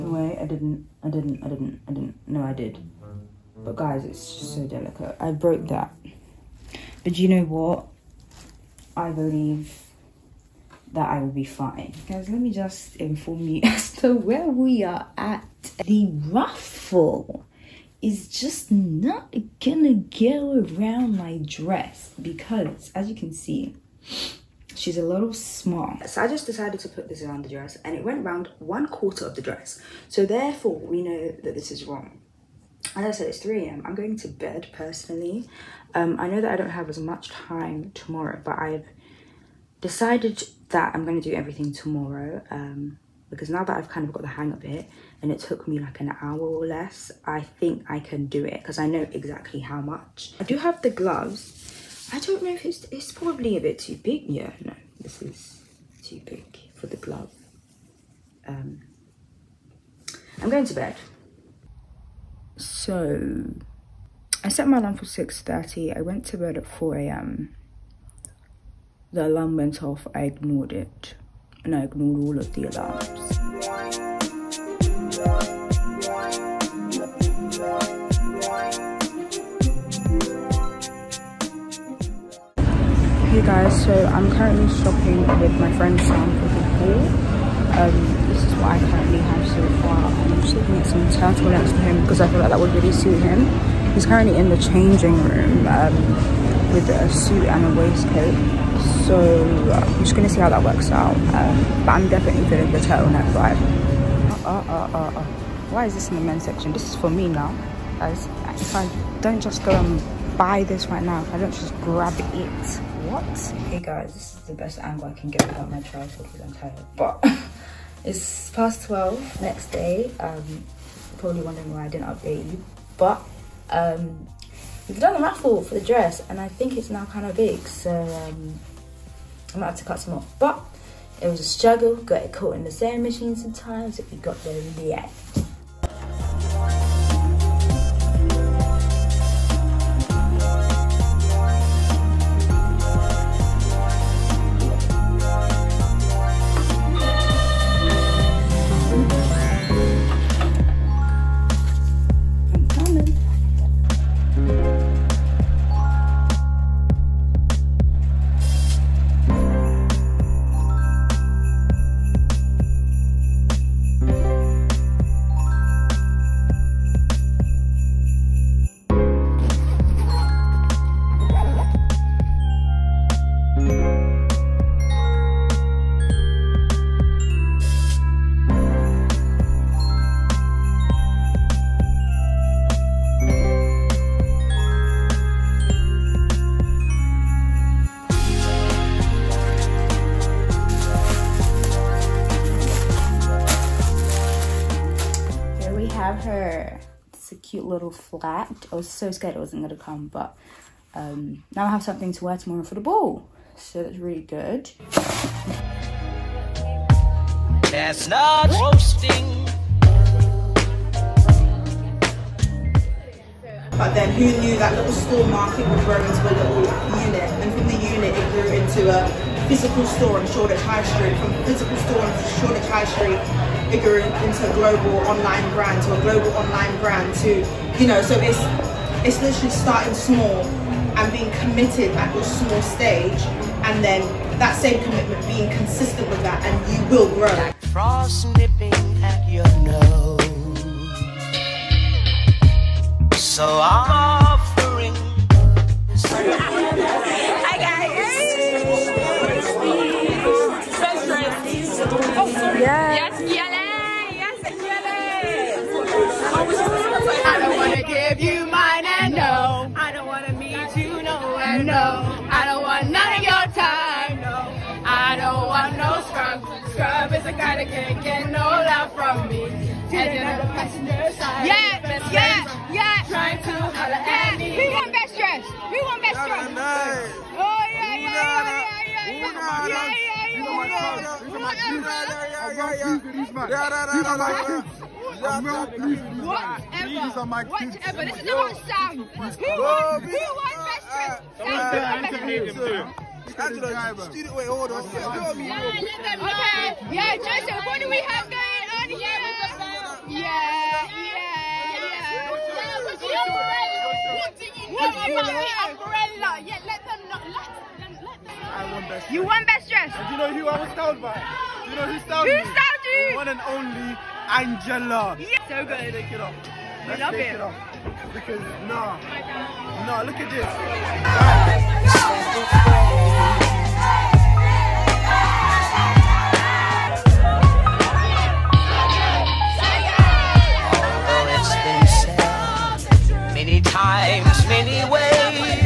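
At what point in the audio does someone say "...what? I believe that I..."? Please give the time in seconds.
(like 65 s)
7 s.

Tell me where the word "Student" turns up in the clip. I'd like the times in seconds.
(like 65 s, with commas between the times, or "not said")
294 s.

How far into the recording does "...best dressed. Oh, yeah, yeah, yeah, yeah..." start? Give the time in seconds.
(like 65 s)
276 s.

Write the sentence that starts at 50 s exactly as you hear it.
I do have the gloves I don't know if it's, it's probably a bit too big.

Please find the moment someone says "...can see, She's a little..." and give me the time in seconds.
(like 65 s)
23 s.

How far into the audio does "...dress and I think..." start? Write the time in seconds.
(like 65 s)
125 s.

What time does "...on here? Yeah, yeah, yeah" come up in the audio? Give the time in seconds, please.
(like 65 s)
298 s.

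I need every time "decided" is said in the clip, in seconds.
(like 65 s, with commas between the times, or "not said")
26 s, 39 s.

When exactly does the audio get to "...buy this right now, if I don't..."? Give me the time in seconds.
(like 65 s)
110 s.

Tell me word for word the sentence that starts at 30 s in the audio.
So therefore we know that this is wrong.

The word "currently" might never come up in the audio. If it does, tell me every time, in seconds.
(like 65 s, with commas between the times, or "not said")
84 s, 88 s, 94 s.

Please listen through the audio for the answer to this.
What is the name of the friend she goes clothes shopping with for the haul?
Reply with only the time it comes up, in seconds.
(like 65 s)
85 s.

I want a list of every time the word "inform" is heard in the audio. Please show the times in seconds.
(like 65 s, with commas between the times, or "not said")
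12 s.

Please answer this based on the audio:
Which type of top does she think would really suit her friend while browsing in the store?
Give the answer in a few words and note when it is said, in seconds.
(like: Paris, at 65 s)
Turtlenecks, at 91 s.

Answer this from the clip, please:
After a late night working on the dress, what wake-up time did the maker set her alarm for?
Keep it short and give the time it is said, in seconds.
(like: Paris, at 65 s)
6:30, at 65 s.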